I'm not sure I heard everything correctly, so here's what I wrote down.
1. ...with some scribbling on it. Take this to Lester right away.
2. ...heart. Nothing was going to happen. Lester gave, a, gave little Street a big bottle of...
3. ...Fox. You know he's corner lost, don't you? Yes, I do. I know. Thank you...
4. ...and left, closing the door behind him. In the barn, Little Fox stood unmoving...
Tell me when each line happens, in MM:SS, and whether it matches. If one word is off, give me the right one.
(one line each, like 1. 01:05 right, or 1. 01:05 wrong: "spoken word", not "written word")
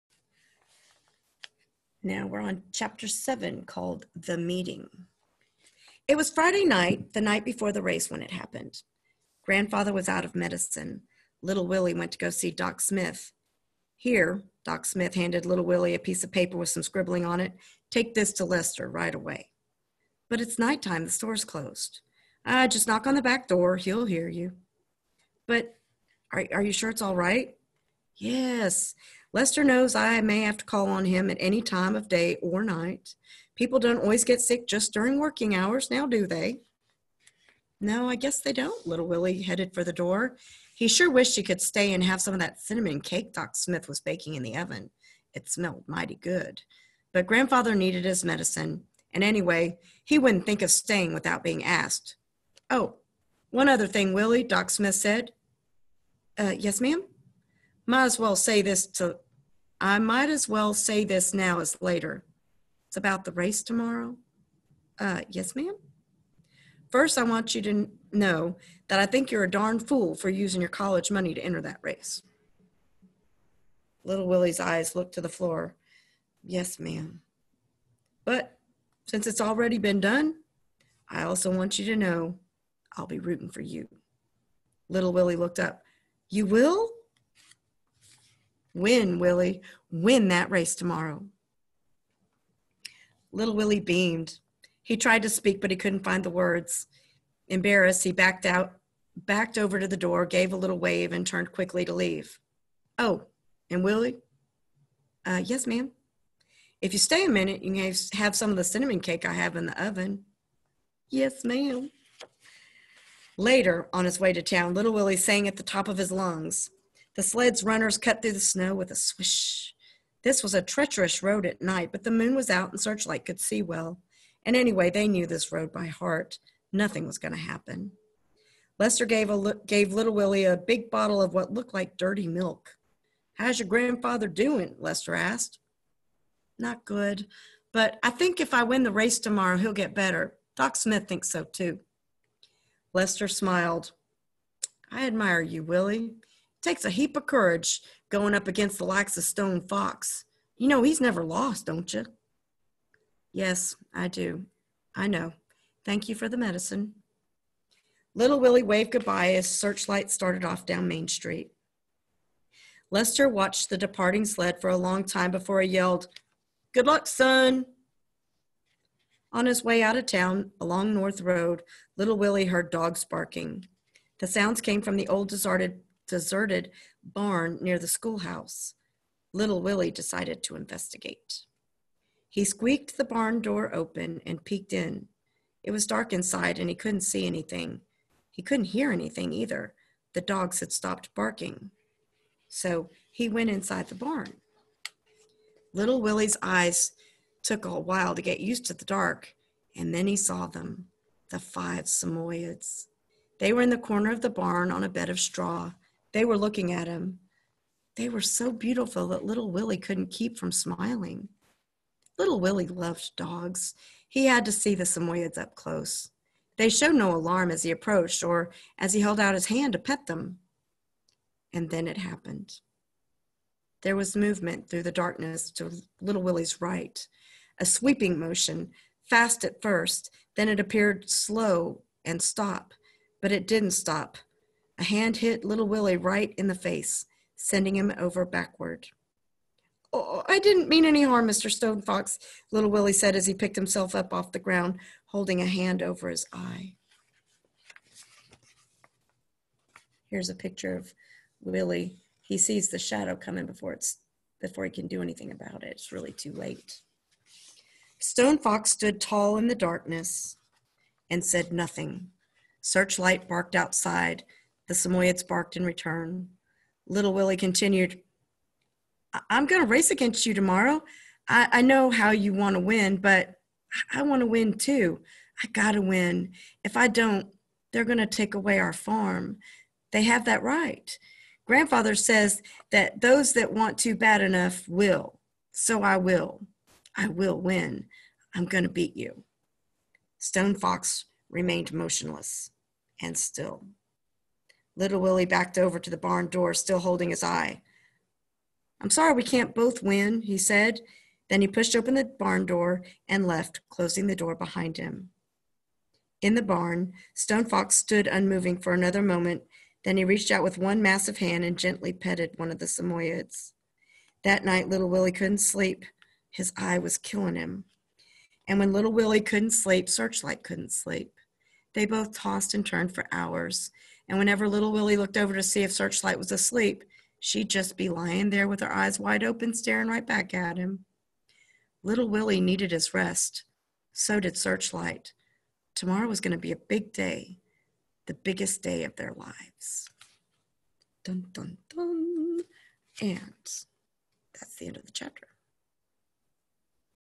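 1. 00:16 right
2. 02:05 wrong: "Willie", not "Street"
3. 02:29 wrong: "never", not "corner"
4. 05:03 wrong: "Stone", not "Little".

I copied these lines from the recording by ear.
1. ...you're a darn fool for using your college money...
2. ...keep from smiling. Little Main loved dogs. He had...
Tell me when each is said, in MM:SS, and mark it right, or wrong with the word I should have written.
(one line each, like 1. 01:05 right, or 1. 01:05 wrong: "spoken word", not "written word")
1. 01:09 right
2. 03:30 wrong: "Willie", not "Main".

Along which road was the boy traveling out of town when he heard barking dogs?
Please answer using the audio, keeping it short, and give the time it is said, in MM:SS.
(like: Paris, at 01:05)
North Road, at 02:50.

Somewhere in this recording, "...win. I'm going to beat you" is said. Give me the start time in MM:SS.
04:47.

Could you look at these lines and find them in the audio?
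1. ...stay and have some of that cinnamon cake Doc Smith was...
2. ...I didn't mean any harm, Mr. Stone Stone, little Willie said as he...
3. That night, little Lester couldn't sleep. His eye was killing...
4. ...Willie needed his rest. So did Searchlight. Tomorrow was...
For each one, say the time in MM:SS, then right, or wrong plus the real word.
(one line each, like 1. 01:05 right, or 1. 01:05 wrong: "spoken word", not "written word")
1. 00:41 right
2. 04:00 wrong: "Fox", not "Stone"
3. 05:14 wrong: "Willie", not "Lester"
4. 05:32 right.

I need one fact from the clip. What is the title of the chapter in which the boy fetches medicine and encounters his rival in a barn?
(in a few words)
The Meeting.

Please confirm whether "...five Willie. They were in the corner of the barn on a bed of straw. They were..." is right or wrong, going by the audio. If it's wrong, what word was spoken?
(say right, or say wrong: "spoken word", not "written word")
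wrong: "Samoyeds", not "Willie".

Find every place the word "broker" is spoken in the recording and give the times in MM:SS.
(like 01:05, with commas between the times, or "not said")
not said.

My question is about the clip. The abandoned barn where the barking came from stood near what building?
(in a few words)
the schoolhouse.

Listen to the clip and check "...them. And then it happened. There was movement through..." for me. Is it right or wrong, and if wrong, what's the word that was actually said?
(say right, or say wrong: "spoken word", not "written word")
right.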